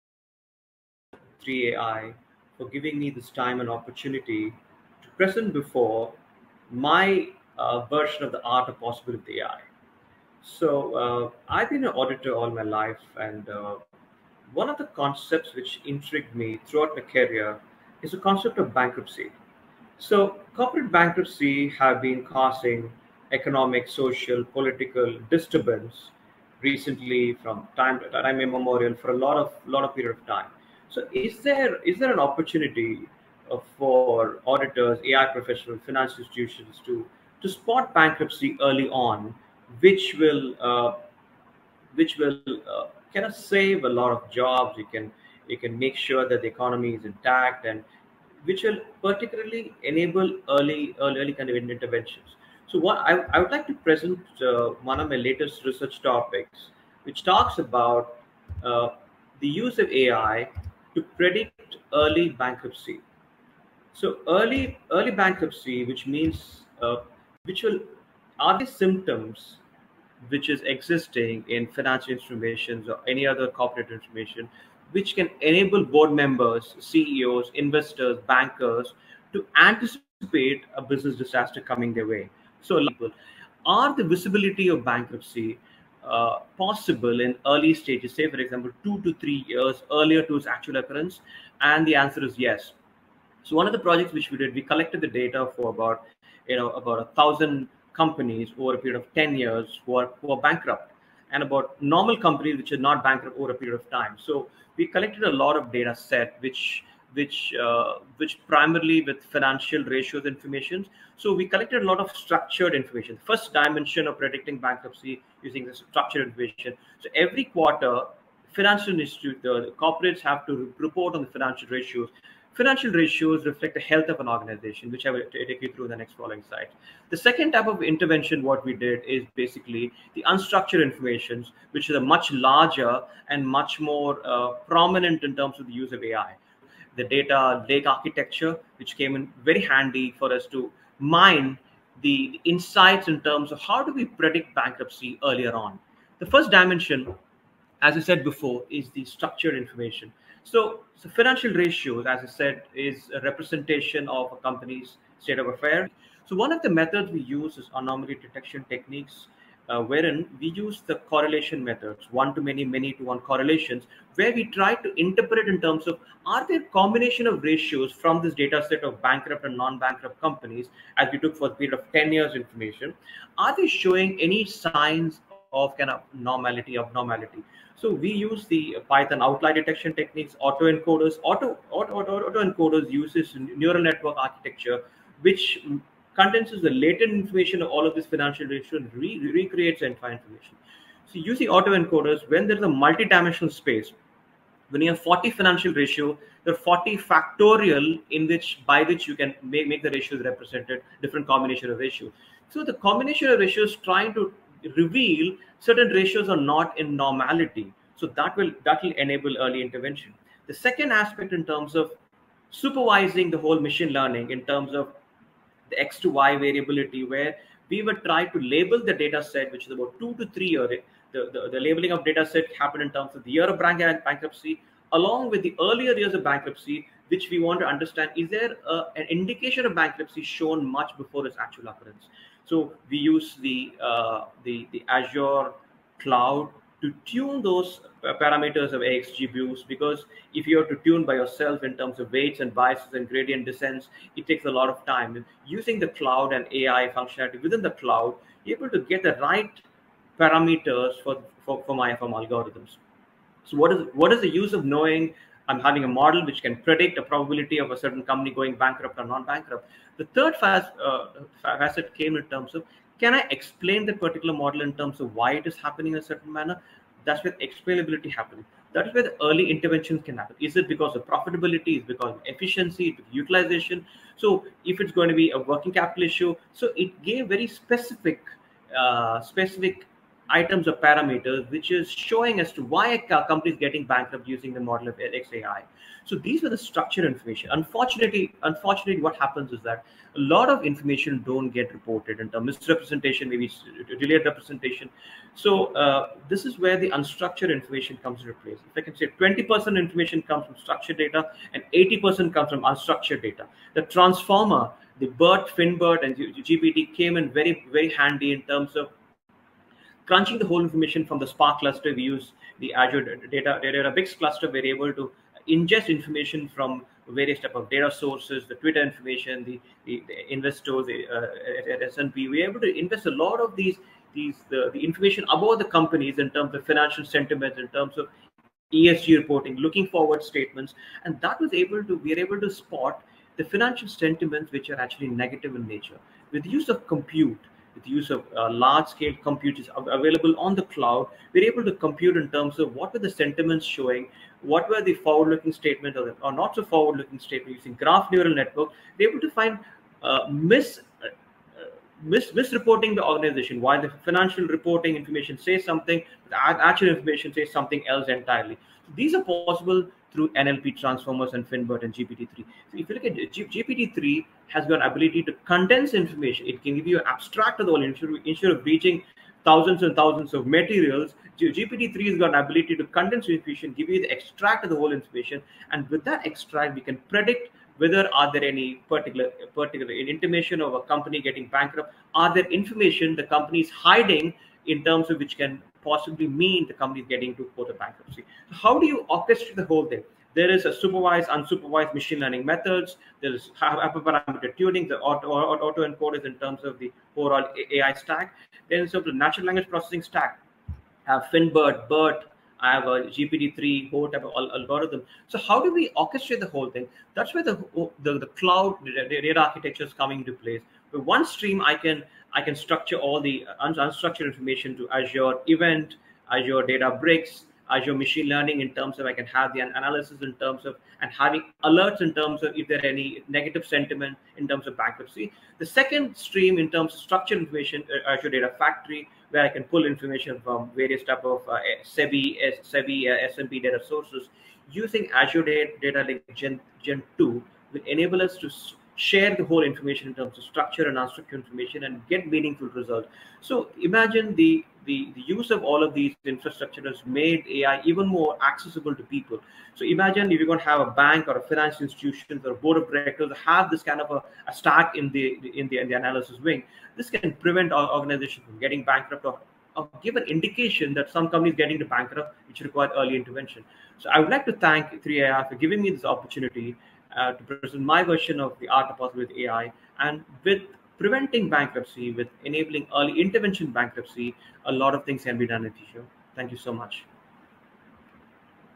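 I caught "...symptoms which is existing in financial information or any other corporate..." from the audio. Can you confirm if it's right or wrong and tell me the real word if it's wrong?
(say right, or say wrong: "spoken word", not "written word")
right.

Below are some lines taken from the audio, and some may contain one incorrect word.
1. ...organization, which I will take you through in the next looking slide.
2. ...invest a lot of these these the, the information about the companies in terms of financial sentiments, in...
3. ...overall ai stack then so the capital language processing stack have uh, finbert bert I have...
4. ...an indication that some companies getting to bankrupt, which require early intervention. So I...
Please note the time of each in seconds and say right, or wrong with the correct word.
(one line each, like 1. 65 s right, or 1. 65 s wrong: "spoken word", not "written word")
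1. 124 s wrong: "following", not "looking"
2. 322 s right
3. 397 s wrong: "natural", not "capital"
4. 460 s right.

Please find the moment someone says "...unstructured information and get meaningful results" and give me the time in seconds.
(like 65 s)
440 s.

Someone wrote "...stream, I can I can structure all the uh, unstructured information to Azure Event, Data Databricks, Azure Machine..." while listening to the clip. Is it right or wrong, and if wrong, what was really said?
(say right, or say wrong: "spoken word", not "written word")
wrong: "Azure", not "Data".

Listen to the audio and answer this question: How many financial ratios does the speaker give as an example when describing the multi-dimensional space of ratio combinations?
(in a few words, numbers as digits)
40.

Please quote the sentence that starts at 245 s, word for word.
using the cloud and AI functionality within the cloud, you're able to get the right parameters for, for, for my FM algorithms.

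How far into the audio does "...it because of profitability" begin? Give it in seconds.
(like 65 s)
270 s.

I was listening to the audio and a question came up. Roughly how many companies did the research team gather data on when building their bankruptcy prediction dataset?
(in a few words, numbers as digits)
1000.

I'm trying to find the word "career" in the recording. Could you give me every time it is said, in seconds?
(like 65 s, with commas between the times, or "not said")
17 s.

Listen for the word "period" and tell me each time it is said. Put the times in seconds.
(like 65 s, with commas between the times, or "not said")
29 s, 98 s, 103 s, 171 s.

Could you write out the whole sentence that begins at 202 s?
So the combination of ratios trying to reveal certain ratios are not in normality.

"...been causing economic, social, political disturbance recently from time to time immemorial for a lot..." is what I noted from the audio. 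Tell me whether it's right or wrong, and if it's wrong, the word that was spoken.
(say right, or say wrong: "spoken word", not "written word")
right.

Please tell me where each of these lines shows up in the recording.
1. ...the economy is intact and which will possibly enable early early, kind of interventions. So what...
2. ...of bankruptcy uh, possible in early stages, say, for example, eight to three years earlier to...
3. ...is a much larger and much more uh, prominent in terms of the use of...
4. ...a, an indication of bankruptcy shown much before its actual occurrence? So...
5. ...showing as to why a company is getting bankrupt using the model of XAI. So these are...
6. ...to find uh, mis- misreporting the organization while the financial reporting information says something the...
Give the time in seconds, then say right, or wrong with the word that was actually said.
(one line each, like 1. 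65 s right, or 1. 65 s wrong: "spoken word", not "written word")
1. 46 s wrong: "particularly", not "possibly"
2. 84 s wrong: "two", not "eight"
3. 131 s right
4. 228 s right
5. 281 s right
6. 349 s right.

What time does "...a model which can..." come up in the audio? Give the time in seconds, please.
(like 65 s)
255 s.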